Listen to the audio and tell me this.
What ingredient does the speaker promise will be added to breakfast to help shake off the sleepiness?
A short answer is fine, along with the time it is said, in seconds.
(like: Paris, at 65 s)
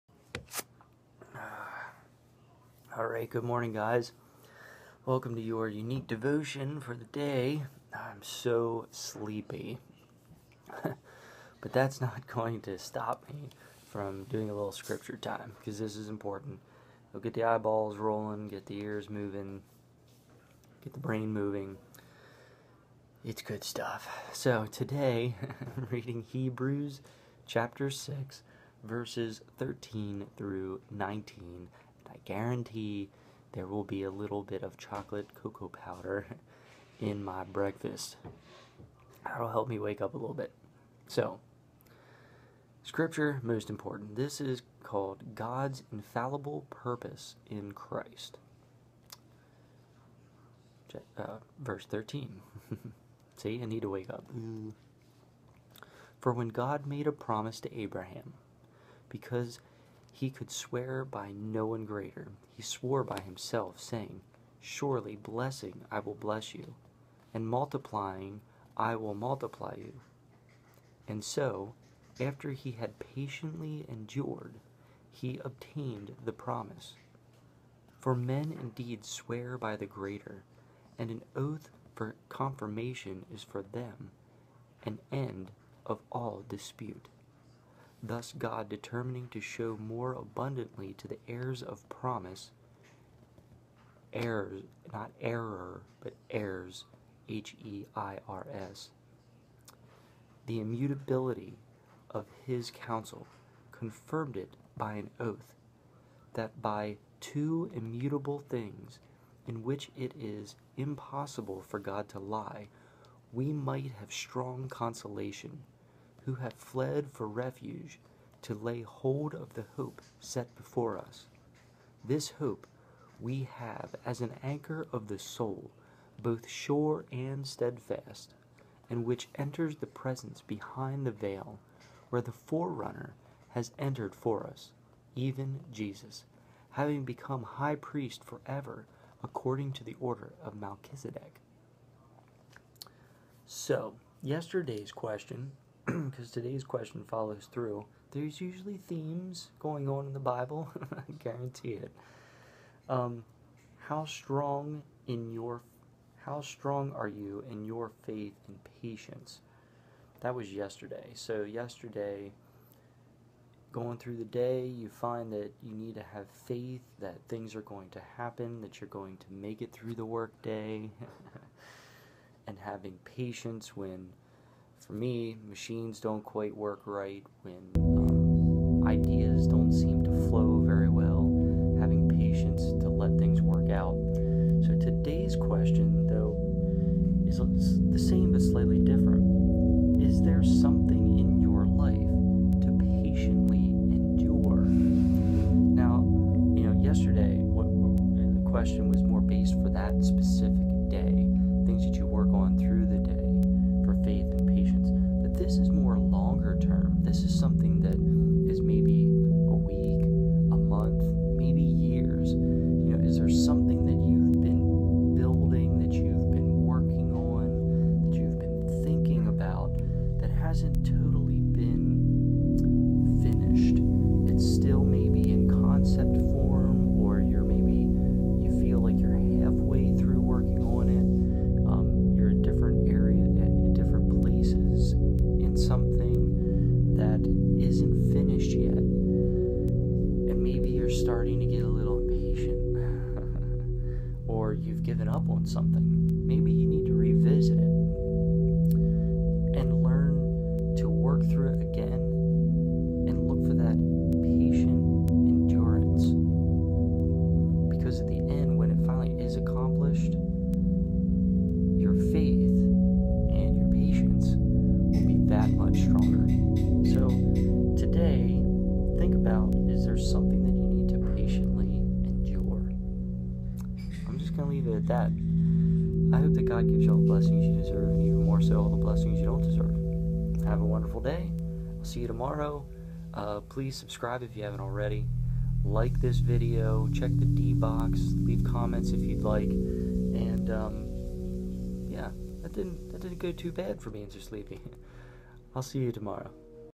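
chocolate cocoa powder, at 34 s.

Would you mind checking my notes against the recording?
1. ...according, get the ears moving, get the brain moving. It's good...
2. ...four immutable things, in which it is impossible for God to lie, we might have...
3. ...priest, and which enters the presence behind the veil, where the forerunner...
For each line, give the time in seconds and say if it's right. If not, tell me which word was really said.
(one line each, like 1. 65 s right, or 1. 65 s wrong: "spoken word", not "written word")
1. 17 s wrong: "rolling", not "according"
2. 107 s wrong: "two", not "four"
3. 127 s wrong: "steadfast", not "priest".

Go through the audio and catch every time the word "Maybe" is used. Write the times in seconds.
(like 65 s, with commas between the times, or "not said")
246 s.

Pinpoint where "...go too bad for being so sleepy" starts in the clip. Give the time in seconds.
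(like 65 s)
293 s.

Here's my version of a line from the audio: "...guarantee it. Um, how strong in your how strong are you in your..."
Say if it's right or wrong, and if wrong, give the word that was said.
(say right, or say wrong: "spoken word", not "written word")
right.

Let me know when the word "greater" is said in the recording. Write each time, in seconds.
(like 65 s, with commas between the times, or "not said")
61 s, 79 s.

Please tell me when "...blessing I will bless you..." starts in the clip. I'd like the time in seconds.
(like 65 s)
65 s.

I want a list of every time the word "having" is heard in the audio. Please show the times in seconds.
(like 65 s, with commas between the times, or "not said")
136 s, 172 s, 181 s.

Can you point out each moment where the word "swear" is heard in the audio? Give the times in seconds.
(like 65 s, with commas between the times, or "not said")
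60 s, 79 s.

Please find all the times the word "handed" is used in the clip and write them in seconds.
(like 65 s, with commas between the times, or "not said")
not said.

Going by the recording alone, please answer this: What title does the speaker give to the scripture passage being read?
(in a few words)
God's infallible purpose in Christ.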